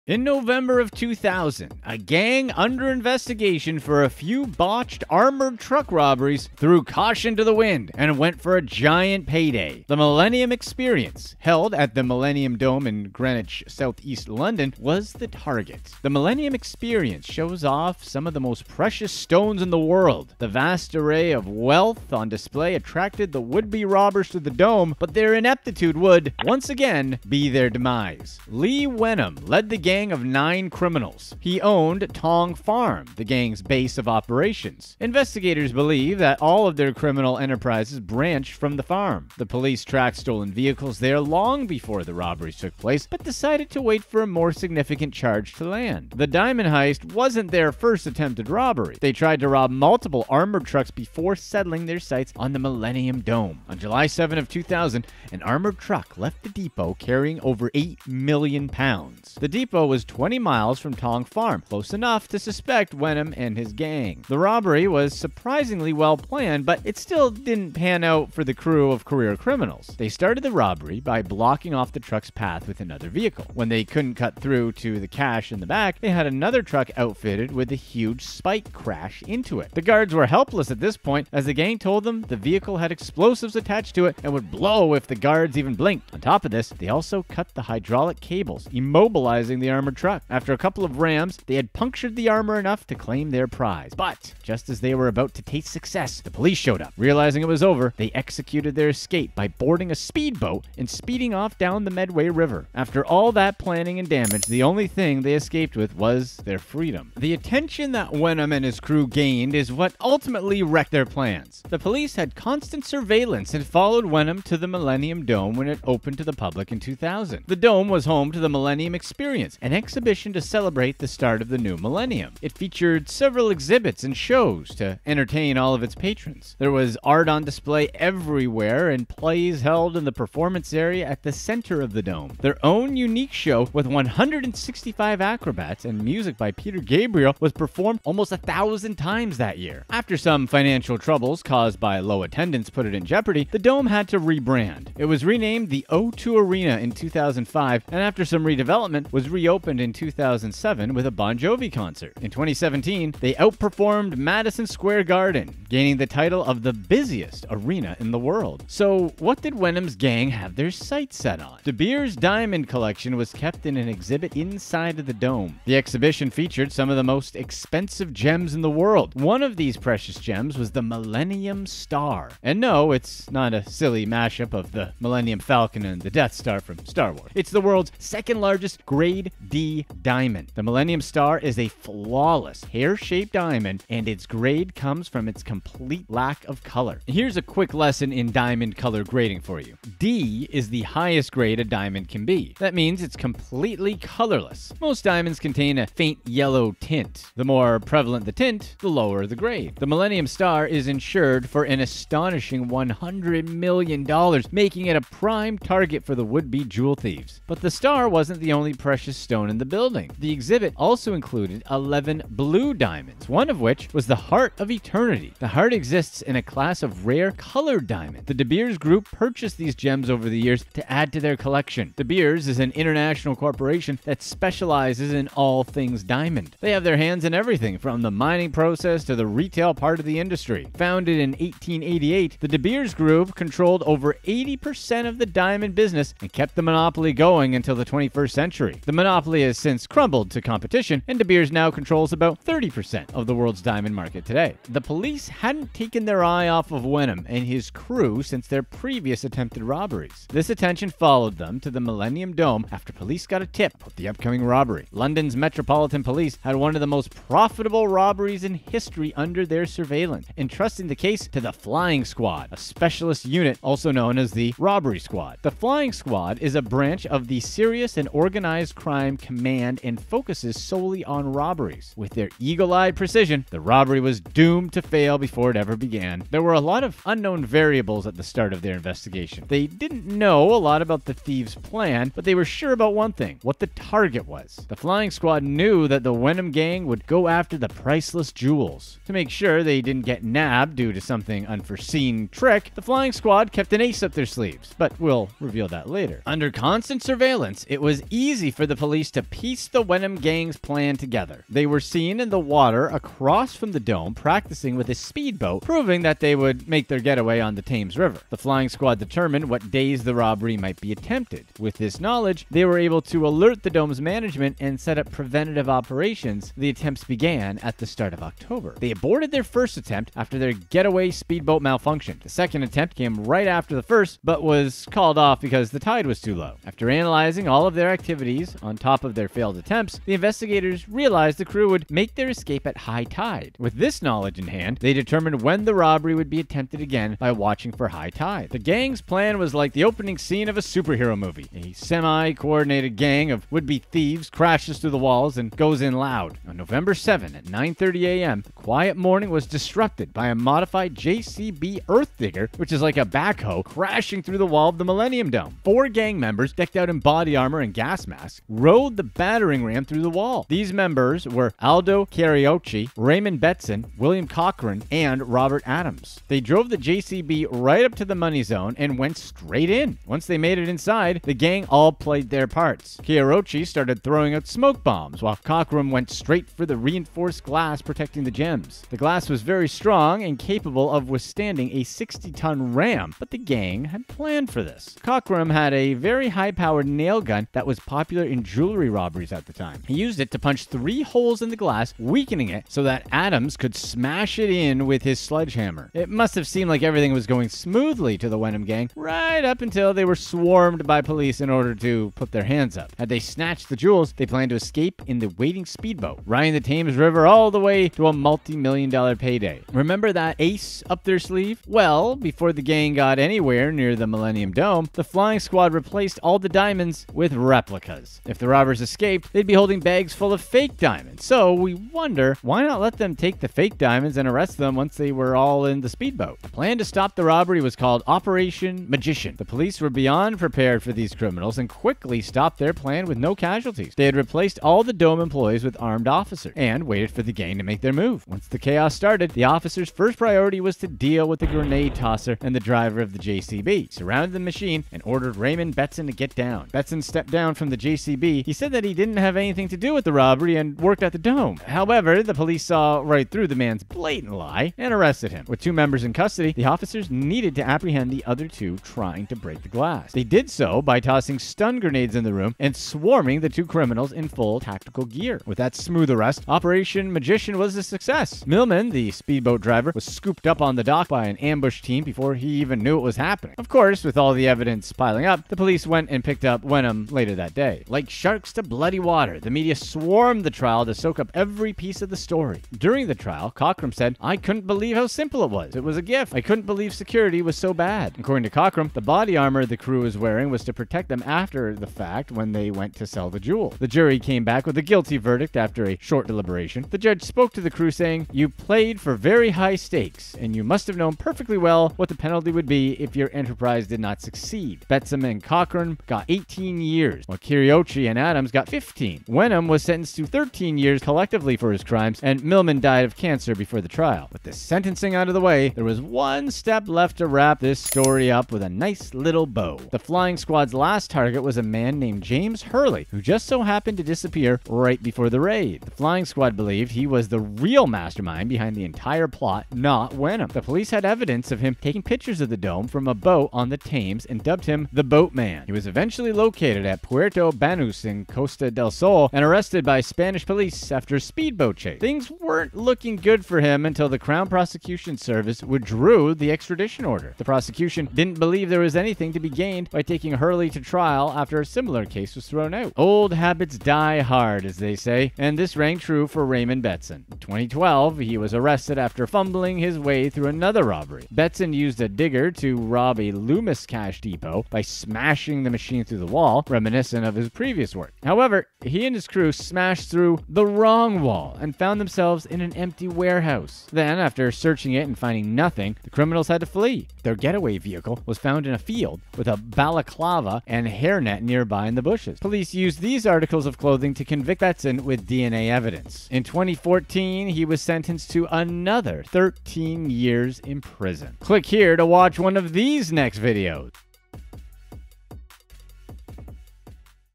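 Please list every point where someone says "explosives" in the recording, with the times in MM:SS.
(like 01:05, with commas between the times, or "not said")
01:22.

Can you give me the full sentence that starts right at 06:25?
Cochran had a very high powered nail gun that was popular in Germany jewelry robberies at the time.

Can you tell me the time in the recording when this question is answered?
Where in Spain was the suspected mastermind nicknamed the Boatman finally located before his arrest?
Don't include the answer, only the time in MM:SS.
08:57.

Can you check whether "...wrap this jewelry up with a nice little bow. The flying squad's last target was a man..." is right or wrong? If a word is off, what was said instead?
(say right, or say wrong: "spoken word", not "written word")
wrong: "story", not "jewelry".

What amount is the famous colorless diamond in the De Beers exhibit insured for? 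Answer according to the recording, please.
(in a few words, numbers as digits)
$100 million.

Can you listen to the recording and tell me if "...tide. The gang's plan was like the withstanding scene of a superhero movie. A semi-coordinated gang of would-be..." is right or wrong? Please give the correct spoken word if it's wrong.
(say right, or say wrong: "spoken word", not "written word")
wrong: "opening", not "withstanding".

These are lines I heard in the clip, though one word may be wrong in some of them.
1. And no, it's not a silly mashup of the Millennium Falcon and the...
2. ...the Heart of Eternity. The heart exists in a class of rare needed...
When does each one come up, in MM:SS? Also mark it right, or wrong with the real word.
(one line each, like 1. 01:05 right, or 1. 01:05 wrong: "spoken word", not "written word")
1. 02:52 right
2. 03:34 wrong: "colored", not "needed".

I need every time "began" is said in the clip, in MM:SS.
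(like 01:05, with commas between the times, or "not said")
04:35, 05:17.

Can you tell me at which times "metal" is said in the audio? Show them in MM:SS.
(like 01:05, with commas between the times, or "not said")
not said.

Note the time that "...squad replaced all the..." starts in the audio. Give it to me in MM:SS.
06:55.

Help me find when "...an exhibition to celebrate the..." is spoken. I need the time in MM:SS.
01:59.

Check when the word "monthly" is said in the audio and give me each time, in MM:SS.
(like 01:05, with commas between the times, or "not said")
not said.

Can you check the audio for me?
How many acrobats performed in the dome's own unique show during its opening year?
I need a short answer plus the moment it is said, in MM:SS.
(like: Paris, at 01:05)
165, at 02:13.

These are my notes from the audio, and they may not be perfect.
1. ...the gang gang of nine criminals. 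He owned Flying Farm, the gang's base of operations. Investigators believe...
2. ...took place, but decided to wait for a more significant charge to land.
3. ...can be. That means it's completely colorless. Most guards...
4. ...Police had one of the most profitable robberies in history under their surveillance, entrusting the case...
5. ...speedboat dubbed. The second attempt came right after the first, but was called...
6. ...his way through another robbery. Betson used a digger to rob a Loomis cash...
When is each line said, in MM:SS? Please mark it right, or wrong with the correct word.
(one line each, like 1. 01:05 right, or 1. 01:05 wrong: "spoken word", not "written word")
1. 00:29 wrong: "Tong", not "Flying"
2. 00:42 right
3. 03:12 wrong: "diamonds", not "guards"
4. 04:16 right
5. 05:21 wrong: "malfunctioned", not "dubbed"
6. 09:19 right.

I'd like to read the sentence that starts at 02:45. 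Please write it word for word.
The exhibition featured some of the most expensive gems in the world.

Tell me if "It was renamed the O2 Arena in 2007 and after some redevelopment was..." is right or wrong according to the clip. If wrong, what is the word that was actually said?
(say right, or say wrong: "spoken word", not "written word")
wrong: "2005", not "2007".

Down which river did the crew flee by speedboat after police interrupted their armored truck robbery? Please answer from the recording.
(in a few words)
Medway River.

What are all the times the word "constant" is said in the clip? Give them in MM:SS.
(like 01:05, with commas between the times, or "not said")
01:52, 04:56.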